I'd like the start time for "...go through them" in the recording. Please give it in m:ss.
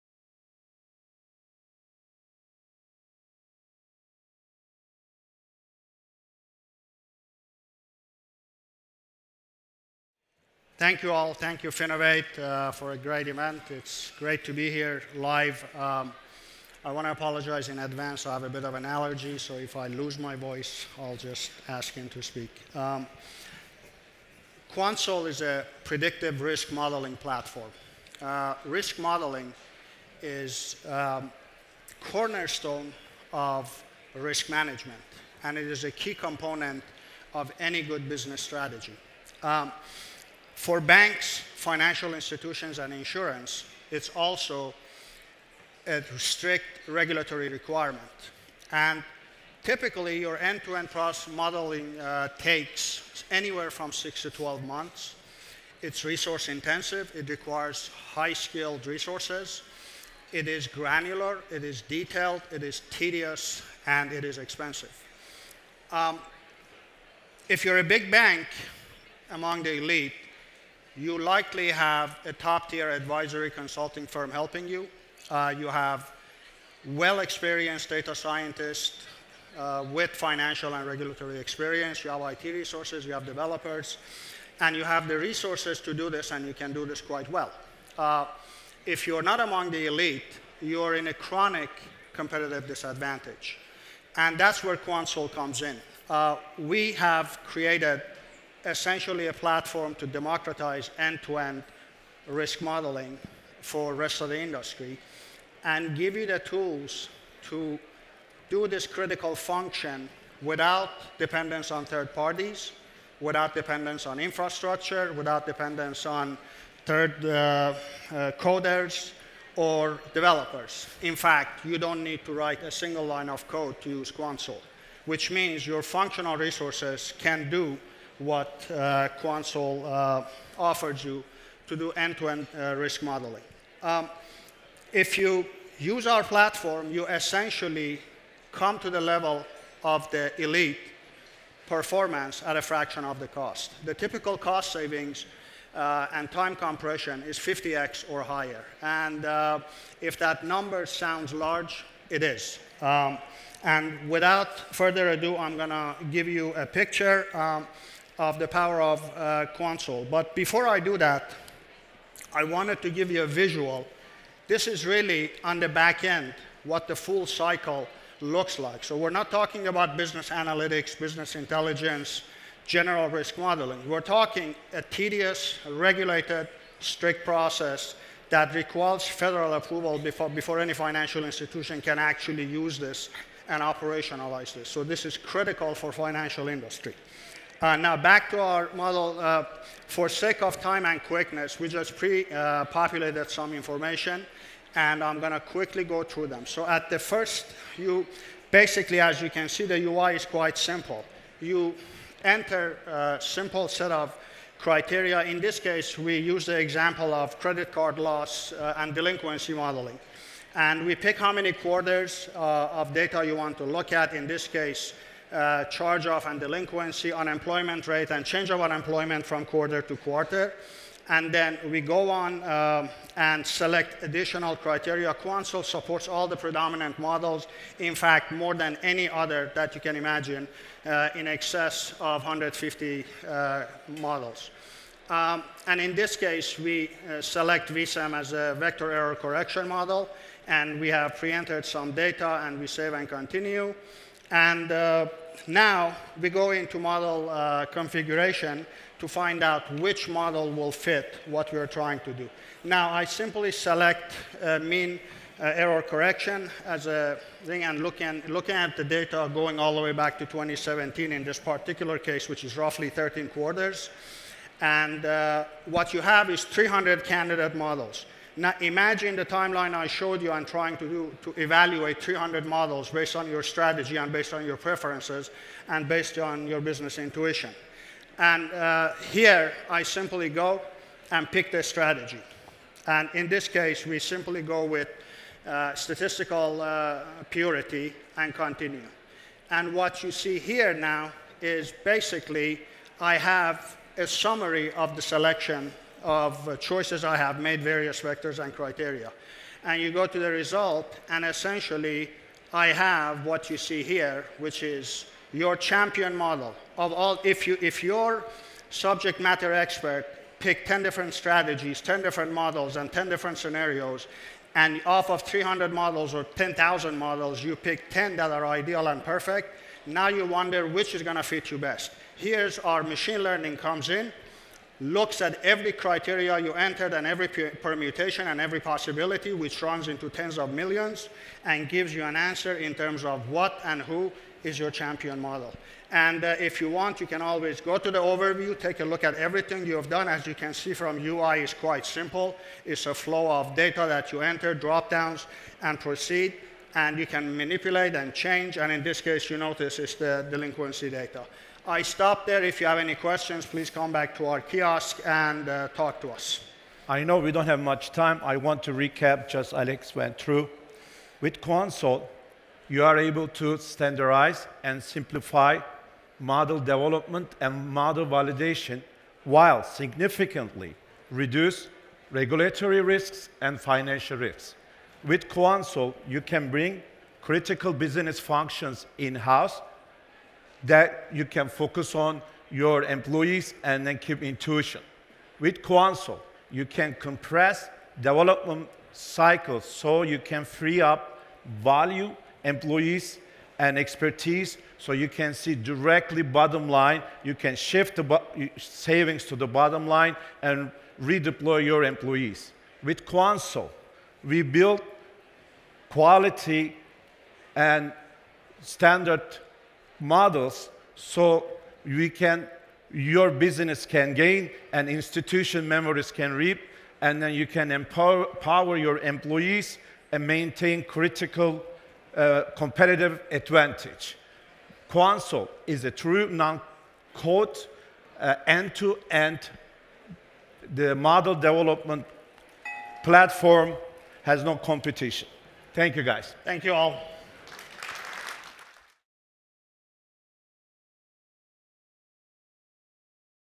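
3:15.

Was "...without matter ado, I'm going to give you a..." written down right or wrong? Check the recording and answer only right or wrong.
wrong.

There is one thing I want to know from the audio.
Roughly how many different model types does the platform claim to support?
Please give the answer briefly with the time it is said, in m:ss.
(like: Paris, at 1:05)
150, at 3:52.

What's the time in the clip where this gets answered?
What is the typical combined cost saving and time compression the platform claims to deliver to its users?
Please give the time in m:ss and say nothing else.
2:27.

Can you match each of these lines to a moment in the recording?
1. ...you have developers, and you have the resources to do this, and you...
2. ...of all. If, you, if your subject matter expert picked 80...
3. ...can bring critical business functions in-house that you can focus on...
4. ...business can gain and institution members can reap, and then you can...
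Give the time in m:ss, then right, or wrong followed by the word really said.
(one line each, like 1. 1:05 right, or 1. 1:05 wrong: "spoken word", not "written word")
1. 1:23 right
2. 5:06 wrong: "10", not "80"
3. 6:16 right
4. 6:53 right.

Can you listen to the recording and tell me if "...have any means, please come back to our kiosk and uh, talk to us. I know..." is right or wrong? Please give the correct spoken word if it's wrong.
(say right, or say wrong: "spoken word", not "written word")
wrong: "questions", not "means".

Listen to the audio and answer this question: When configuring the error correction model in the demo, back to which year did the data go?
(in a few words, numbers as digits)
2017.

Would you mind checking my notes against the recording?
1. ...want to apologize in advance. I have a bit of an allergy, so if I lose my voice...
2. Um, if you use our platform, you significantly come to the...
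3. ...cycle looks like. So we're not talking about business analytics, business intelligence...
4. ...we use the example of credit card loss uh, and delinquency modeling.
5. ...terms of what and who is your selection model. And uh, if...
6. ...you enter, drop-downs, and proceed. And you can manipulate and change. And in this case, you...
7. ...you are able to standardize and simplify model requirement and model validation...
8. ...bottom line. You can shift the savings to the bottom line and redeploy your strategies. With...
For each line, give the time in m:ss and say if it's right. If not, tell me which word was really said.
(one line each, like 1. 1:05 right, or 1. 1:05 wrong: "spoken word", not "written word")
1. 0:16 right
2. 2:13 wrong: "essentially", not "significantly"
3. 2:47 right
4. 3:25 right
5. 5:32 wrong: "champion", not "selection"
6. 5:44 right
7. 6:02 wrong: "development", not "requirement"
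8. 6:36 wrong: "employees", not "strategies".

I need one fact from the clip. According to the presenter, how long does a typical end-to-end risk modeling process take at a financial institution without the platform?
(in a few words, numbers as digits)
6 to 12 months.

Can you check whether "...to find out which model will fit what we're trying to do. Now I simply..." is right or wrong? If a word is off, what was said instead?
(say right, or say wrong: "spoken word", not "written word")
right.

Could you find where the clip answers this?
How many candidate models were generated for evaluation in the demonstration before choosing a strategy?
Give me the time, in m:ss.
4:26.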